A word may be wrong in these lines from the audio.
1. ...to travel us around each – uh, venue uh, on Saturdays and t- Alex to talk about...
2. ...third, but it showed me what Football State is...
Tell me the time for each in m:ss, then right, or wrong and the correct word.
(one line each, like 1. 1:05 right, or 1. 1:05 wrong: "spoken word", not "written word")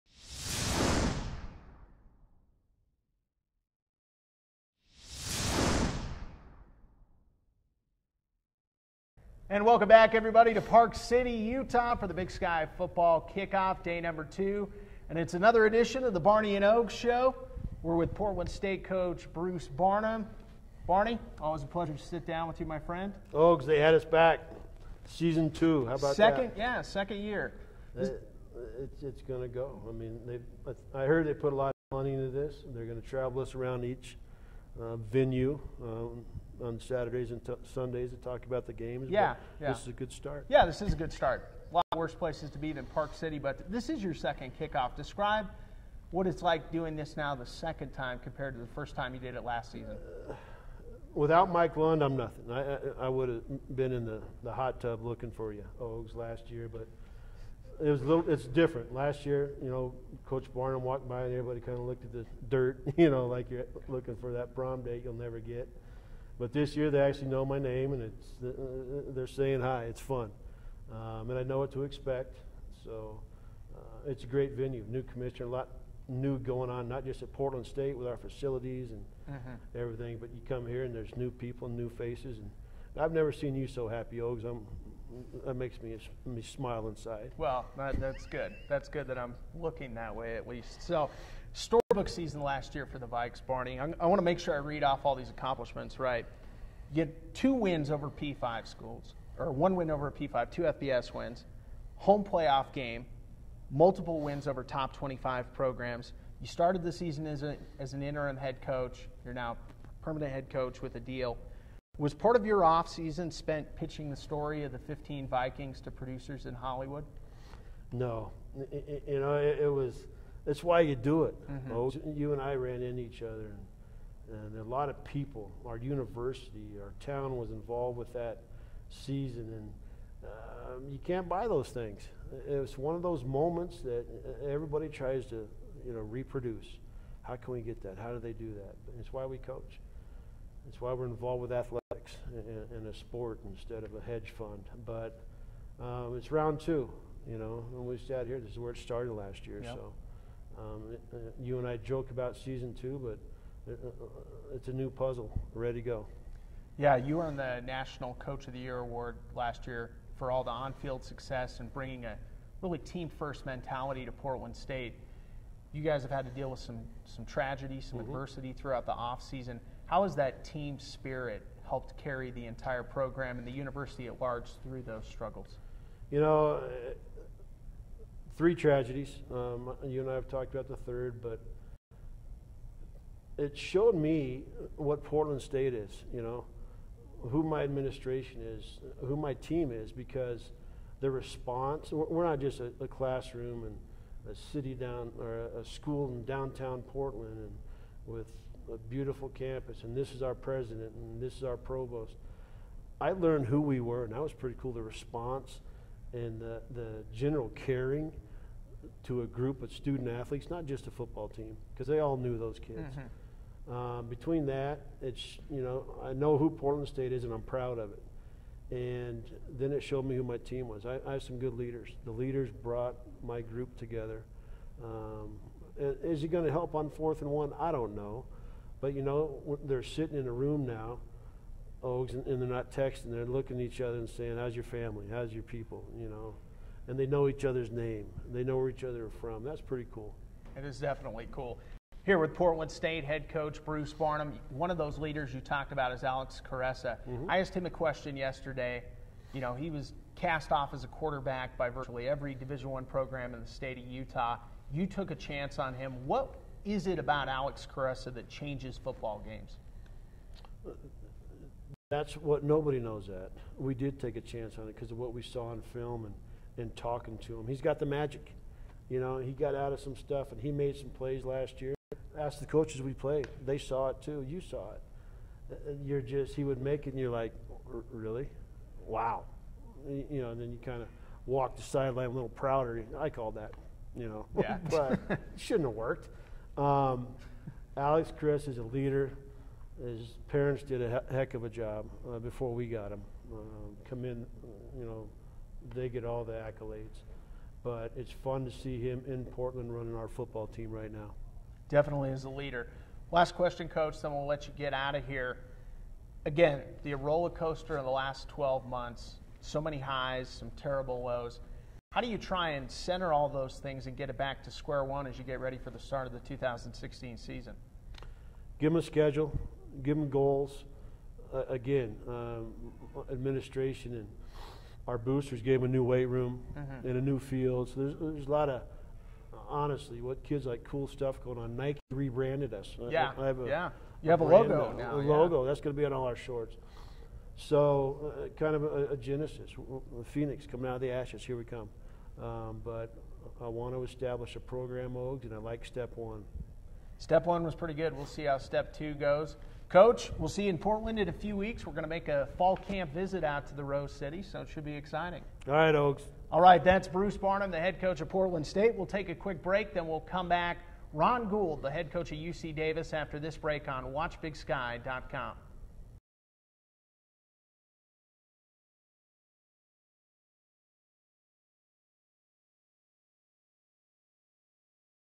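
1. 0:33 wrong: "Sundays", not "Alex"
2. 3:00 wrong: "Portland", not "Football".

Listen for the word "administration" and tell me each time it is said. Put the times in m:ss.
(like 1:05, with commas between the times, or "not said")
3:07, 5:23.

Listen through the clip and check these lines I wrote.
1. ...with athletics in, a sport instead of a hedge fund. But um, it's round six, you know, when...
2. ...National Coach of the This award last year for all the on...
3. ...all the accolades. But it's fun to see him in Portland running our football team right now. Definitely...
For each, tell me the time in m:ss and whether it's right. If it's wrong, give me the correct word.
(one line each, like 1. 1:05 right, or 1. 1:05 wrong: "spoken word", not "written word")
1. 2:21 wrong: "two", not "six"
2. 2:37 wrong: "Year", not "This"
3. 4:56 right.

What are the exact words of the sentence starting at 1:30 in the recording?
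So, storybook season last year for the Vikes, Barney.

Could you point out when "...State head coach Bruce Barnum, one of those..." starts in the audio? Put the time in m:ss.
4:02.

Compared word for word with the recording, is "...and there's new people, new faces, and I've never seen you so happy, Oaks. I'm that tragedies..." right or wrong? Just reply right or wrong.
wrong.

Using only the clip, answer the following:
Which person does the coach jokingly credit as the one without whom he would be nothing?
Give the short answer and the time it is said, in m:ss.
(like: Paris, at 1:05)
Mike Lund, at 0:51.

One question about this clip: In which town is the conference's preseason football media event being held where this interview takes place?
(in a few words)
Park City, Utah.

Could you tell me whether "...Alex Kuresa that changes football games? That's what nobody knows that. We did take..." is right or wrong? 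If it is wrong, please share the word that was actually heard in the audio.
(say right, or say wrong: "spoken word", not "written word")
right.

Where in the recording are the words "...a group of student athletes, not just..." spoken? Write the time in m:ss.
3:29.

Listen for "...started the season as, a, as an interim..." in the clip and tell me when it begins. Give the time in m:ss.
1:46.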